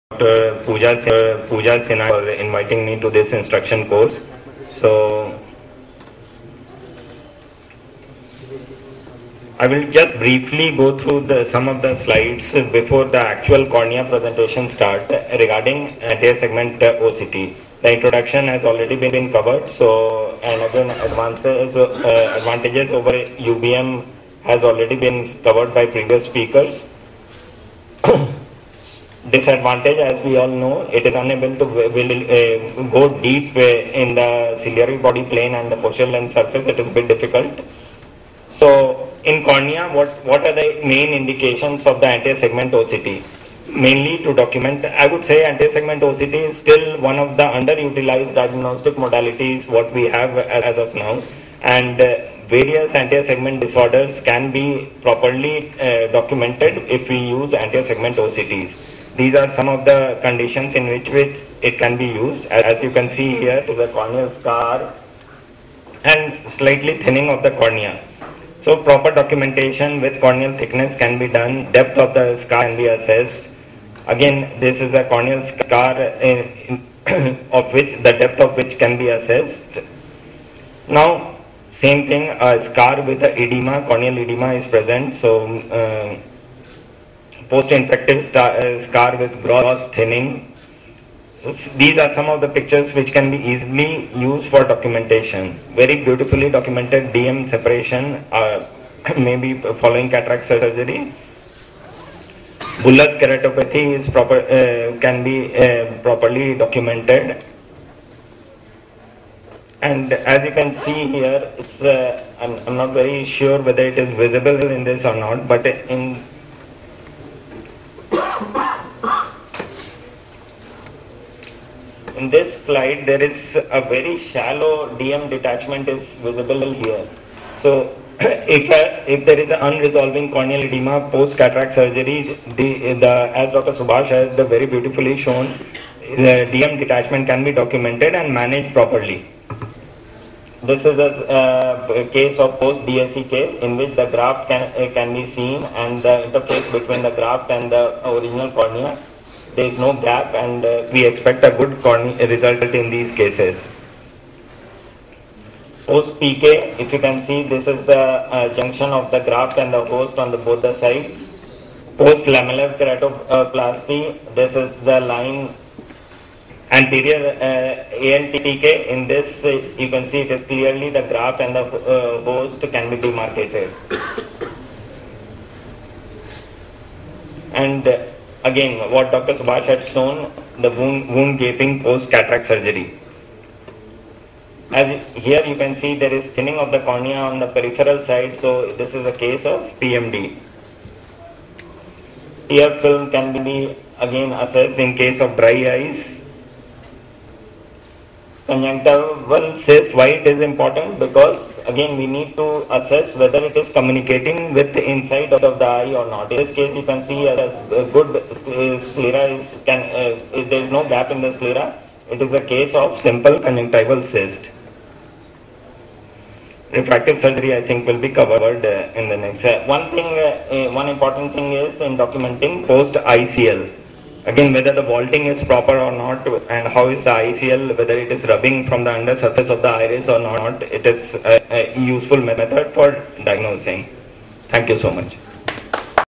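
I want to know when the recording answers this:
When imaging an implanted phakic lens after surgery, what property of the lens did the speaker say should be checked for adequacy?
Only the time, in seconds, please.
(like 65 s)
224 s.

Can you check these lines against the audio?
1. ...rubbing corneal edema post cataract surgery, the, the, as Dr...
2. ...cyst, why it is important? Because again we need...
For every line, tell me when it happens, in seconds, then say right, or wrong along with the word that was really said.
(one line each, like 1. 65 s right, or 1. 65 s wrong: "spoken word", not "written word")
1. 129 s wrong: "unresolving", not "rubbing"
2. 199 s right.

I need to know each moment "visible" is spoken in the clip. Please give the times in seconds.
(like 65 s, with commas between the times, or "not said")
114 s, 126 s.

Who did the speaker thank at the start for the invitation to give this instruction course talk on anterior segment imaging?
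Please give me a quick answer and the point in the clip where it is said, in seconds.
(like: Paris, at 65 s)
Pooja Sinha, at 1 s.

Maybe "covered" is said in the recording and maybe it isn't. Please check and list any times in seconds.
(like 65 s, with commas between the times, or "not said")
19 s, 25 s, 218 s.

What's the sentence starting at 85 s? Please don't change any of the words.
So, mm, uh, post-infective uh, scar with gross thinning.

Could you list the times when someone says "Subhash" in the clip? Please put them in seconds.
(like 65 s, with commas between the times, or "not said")
133 s, 179 s.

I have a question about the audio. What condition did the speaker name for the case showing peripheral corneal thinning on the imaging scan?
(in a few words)
PMD.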